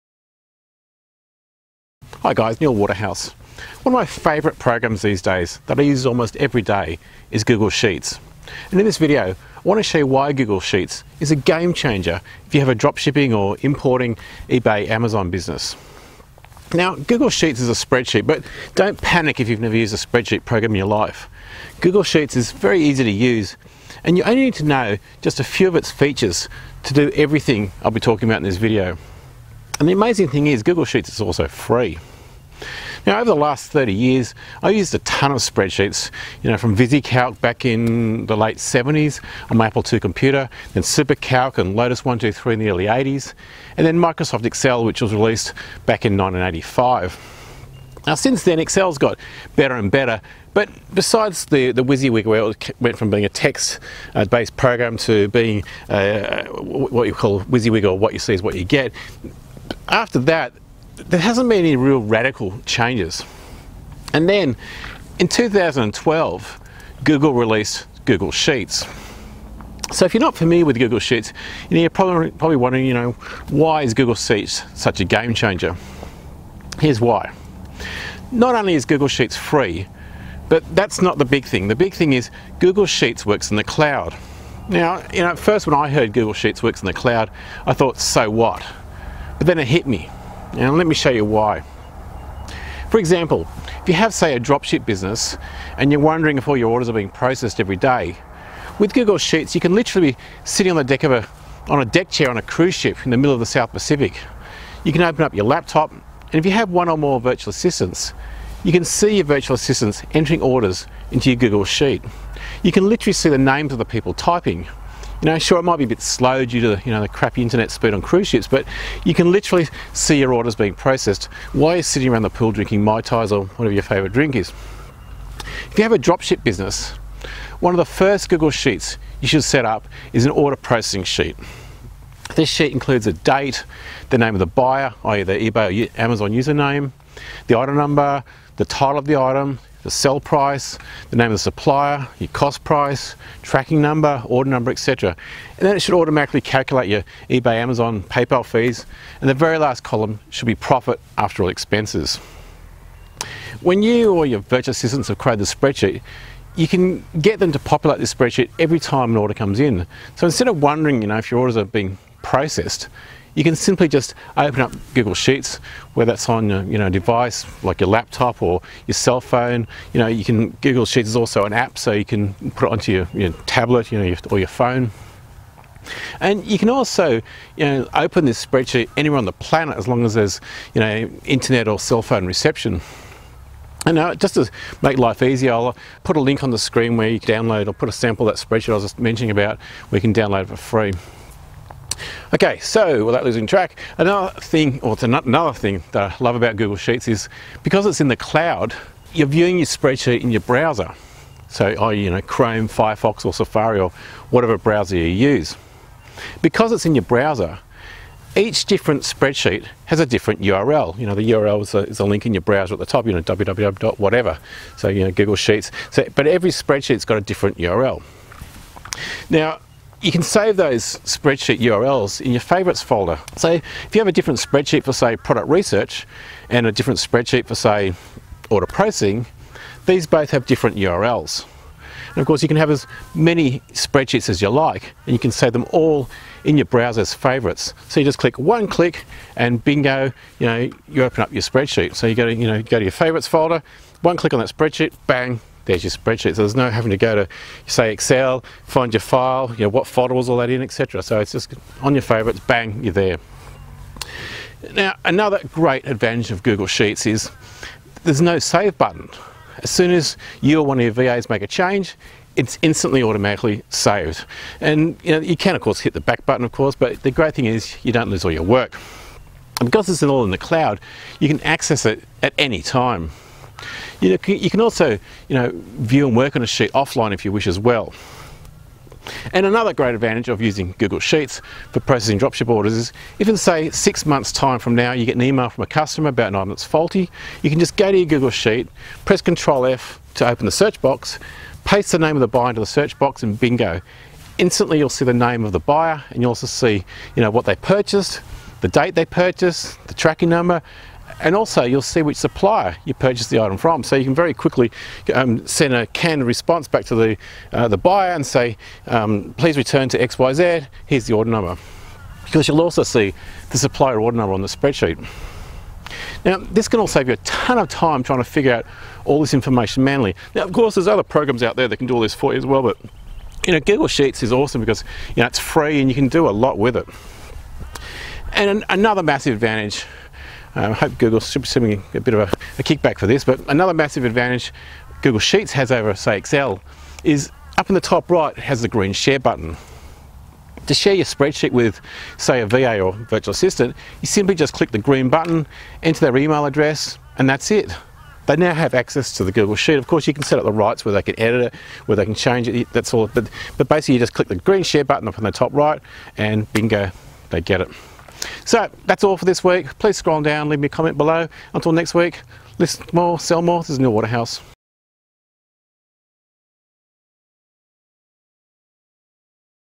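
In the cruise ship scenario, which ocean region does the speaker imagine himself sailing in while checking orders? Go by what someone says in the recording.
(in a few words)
South Pacific.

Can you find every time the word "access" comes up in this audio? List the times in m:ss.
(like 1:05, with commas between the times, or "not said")
4:31, 5:48.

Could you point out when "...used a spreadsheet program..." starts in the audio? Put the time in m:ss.
0:19.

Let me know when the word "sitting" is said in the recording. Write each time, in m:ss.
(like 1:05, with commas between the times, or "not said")
1:40, 2:01.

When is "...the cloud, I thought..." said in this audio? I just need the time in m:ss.
1:26.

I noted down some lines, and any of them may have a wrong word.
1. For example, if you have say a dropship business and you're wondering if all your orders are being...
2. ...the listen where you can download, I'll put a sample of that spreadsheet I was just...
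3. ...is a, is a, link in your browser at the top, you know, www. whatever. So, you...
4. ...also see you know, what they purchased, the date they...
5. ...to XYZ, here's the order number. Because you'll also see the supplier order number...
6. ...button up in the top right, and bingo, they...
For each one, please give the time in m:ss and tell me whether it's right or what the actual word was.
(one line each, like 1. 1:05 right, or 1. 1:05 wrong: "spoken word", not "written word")
1. 1:32 right
2. 3:06 wrong: "screen", not "listen"
3. 3:31 right
4. 4:56 right
5. 5:09 right
6. 5:54 right.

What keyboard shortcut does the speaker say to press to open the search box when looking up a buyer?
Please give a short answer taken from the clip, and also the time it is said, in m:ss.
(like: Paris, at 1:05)
Control F, at 4:49.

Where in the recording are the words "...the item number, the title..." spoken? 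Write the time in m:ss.
2:17.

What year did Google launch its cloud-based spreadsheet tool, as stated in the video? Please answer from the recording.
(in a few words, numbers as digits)
2012.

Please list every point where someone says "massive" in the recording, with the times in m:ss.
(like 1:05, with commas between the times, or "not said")
5:29, 5:33.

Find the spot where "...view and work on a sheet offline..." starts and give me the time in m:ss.
4:35.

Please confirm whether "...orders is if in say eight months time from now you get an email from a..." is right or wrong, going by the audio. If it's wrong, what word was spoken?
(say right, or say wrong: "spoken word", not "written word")
wrong: "six", not "eight".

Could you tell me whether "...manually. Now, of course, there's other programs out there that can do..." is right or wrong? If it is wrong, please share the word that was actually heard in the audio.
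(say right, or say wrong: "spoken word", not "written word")
right.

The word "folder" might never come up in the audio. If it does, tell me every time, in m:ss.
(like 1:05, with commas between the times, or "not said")
3:42, 4:03, 4:09.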